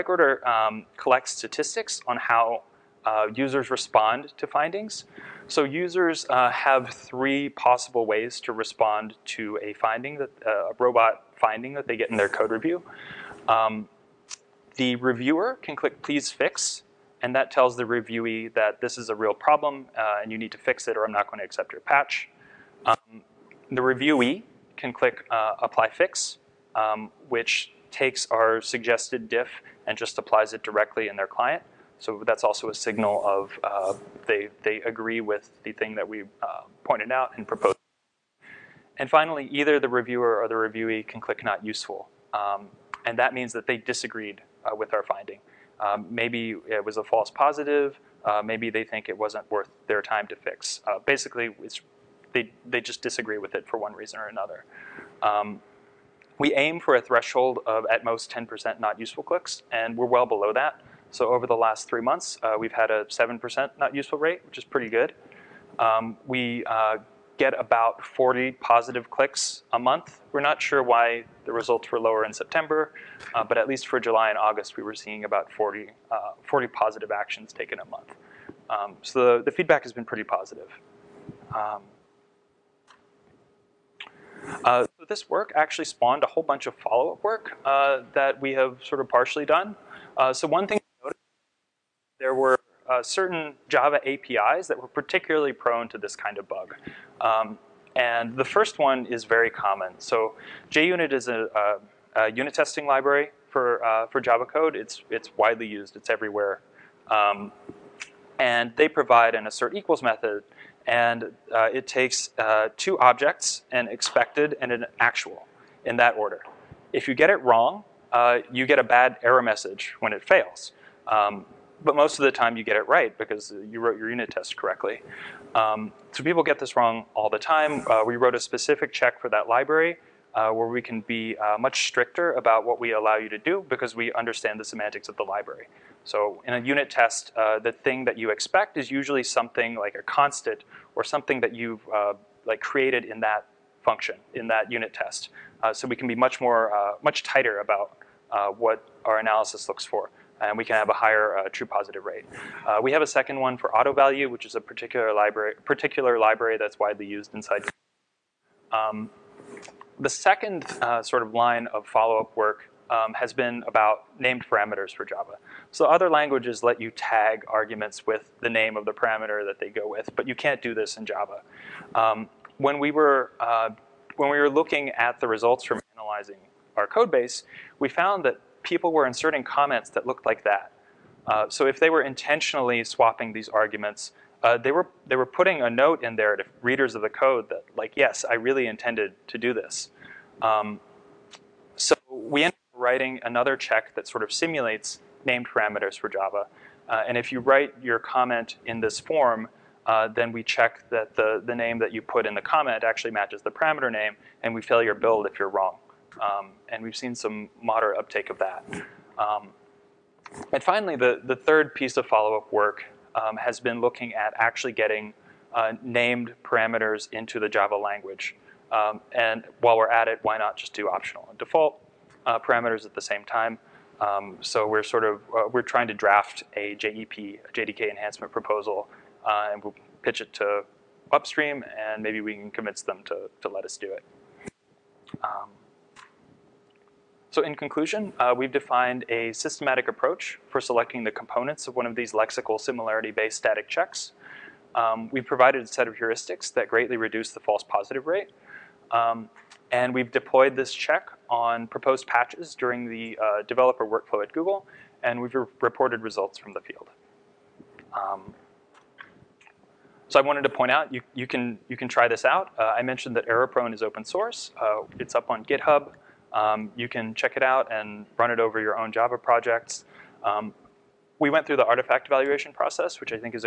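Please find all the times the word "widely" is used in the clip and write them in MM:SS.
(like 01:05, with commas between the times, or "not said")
01:45, 02:36.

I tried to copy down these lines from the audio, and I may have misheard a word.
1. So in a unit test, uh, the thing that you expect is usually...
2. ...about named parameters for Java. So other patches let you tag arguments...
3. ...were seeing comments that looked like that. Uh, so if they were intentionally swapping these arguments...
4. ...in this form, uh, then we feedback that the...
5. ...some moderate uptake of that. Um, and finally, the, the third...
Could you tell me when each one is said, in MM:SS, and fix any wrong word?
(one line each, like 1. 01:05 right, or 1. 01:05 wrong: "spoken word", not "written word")
1. 02:16 right
2. 02:43 wrong: "languages", not "patches"
3. 02:58 wrong: "inserting", not "seeing"
4. 03:18 wrong: "check", not "feedback"
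5. 03:27 right.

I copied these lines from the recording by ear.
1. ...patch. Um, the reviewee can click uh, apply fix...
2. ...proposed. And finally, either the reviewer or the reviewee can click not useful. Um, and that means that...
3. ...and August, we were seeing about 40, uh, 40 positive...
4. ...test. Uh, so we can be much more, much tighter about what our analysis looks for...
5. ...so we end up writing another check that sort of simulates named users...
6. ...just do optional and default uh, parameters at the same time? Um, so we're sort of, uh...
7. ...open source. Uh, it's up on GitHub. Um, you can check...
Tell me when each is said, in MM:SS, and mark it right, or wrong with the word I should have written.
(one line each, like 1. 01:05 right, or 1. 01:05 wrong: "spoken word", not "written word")
1. 00:21 right
2. 00:37 right
3. 01:14 right
4. 02:24 right
5. 03:11 wrong: "parameters", not "users"
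6. 03:40 right
7. 04:23 right.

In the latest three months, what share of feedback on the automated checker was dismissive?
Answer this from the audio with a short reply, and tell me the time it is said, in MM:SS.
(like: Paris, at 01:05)
7%, at 01:03.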